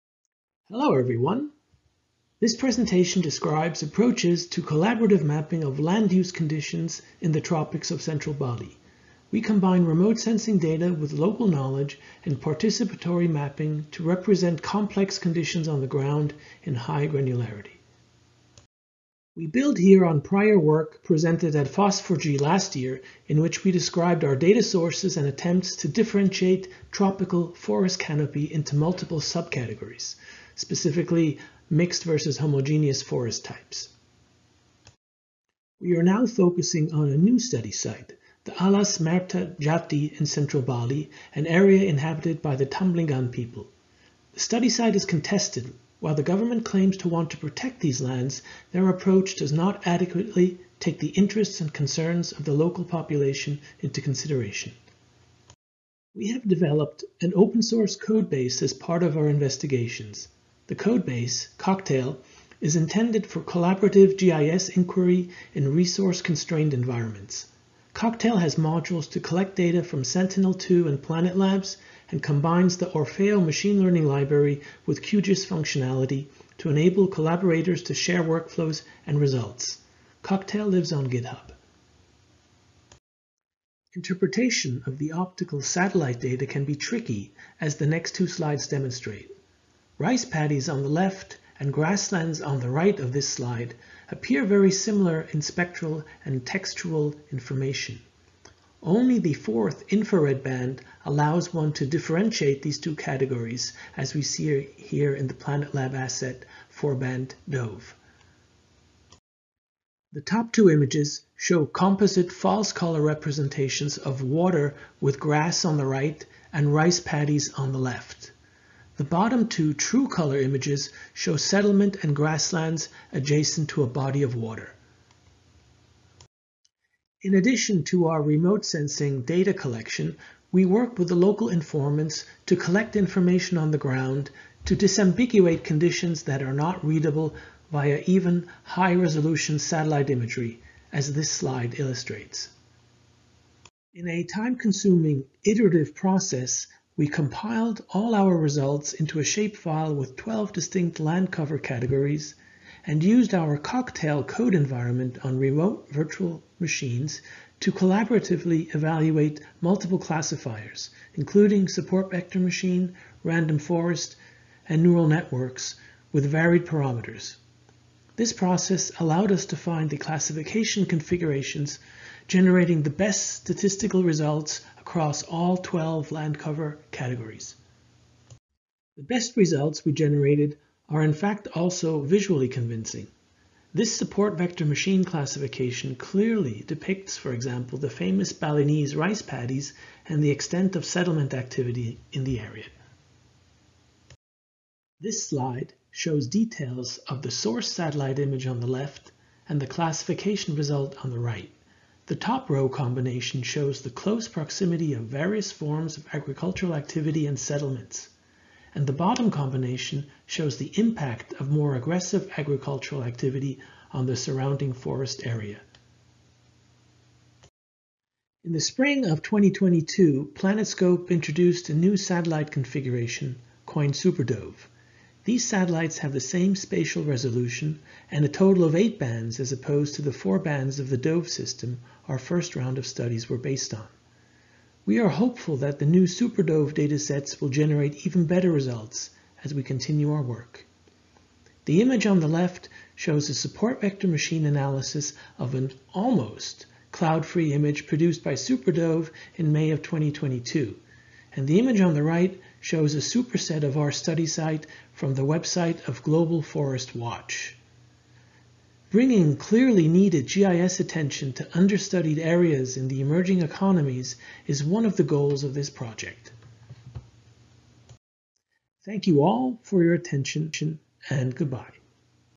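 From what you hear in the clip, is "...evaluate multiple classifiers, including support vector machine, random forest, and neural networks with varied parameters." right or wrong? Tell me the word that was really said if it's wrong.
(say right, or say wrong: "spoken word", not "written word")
right.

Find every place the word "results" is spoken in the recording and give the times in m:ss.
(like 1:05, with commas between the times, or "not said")
1:19, 2:28, 2:54, 2:59, 3:20, 3:58.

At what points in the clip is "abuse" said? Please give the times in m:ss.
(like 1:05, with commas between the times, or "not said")
not said.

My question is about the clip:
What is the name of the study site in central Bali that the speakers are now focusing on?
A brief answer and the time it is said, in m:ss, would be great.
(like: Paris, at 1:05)
Alas Merta Jati, at 0:38.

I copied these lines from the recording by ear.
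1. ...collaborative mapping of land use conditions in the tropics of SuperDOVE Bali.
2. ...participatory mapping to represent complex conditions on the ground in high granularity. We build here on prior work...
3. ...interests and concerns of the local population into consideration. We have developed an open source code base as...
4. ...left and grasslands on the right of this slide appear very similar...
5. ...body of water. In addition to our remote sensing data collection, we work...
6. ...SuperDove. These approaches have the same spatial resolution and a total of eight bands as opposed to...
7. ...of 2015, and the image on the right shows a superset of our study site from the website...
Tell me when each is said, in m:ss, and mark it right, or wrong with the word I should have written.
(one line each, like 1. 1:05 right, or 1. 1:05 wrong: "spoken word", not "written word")
1. 0:04 wrong: "Central", not "SuperDOVE"
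2. 0:12 right
3. 0:51 right
4. 1:30 right
5. 2:03 right
6. 3:43 wrong: "satellites", not "approaches"
7. 4:09 wrong: "2022", not "2015".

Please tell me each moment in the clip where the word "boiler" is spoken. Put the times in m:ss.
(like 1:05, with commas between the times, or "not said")
not said.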